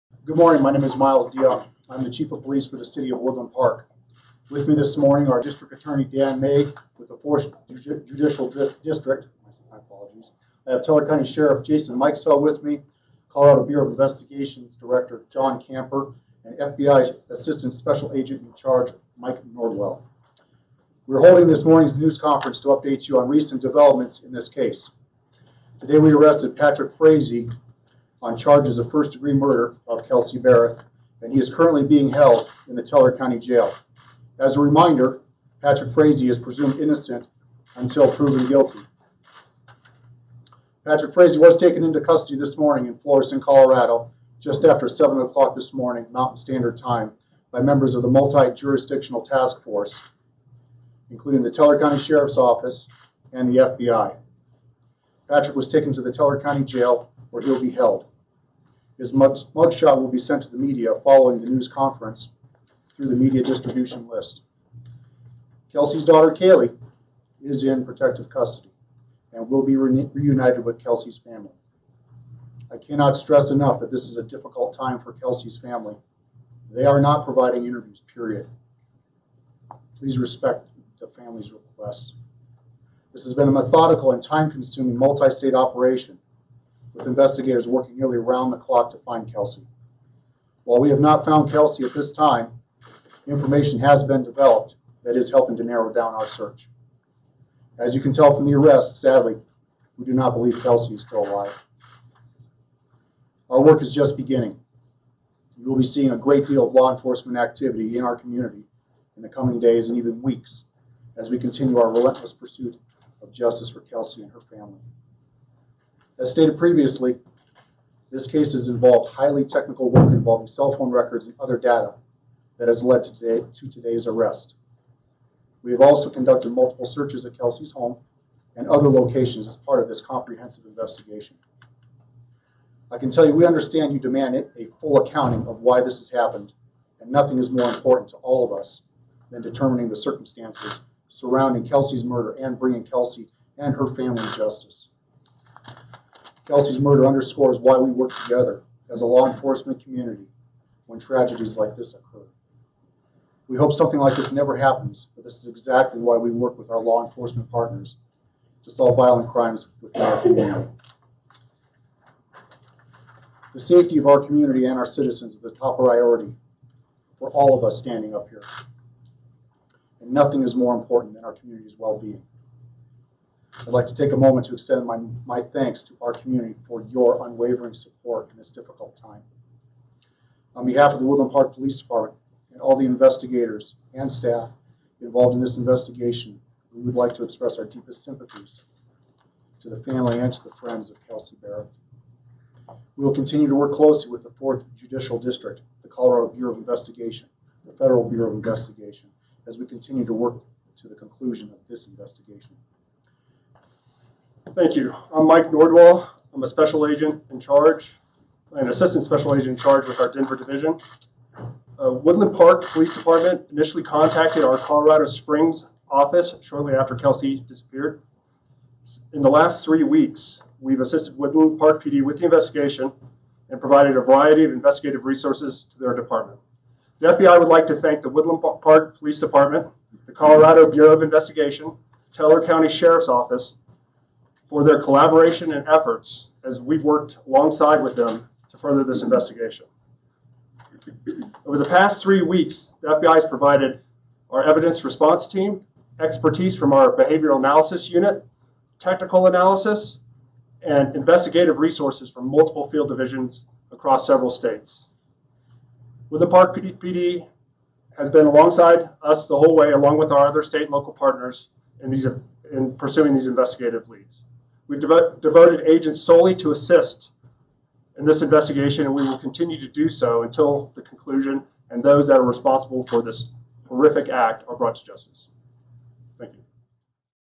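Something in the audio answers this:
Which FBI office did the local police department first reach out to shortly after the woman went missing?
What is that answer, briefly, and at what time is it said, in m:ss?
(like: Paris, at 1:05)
Colorado Springs, at 3:34.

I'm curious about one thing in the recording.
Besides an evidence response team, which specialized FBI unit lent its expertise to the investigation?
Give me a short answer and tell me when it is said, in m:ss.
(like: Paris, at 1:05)
behavioral analysis unit, at 4:06.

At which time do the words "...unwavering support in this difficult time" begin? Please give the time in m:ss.
2:57.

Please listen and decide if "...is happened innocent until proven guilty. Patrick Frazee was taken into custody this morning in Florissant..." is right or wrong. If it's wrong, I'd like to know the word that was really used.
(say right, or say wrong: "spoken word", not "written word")
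wrong: "presumed", not "happened".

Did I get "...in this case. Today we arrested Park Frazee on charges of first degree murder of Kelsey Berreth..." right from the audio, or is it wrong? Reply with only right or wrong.
wrong.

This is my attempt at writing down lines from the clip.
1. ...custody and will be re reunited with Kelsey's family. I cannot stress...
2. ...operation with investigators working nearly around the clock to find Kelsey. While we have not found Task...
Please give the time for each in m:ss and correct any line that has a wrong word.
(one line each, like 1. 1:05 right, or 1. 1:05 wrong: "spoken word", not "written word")
1. 1:08 right
2. 1:25 wrong: "Kelsey", not "Task".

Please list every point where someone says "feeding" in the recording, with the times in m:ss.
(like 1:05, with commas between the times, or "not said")
not said.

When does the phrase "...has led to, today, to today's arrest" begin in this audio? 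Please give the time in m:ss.
2:02.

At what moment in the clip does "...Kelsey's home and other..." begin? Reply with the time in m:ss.
2:07.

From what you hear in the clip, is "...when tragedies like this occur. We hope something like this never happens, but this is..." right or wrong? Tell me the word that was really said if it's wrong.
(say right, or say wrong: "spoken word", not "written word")
right.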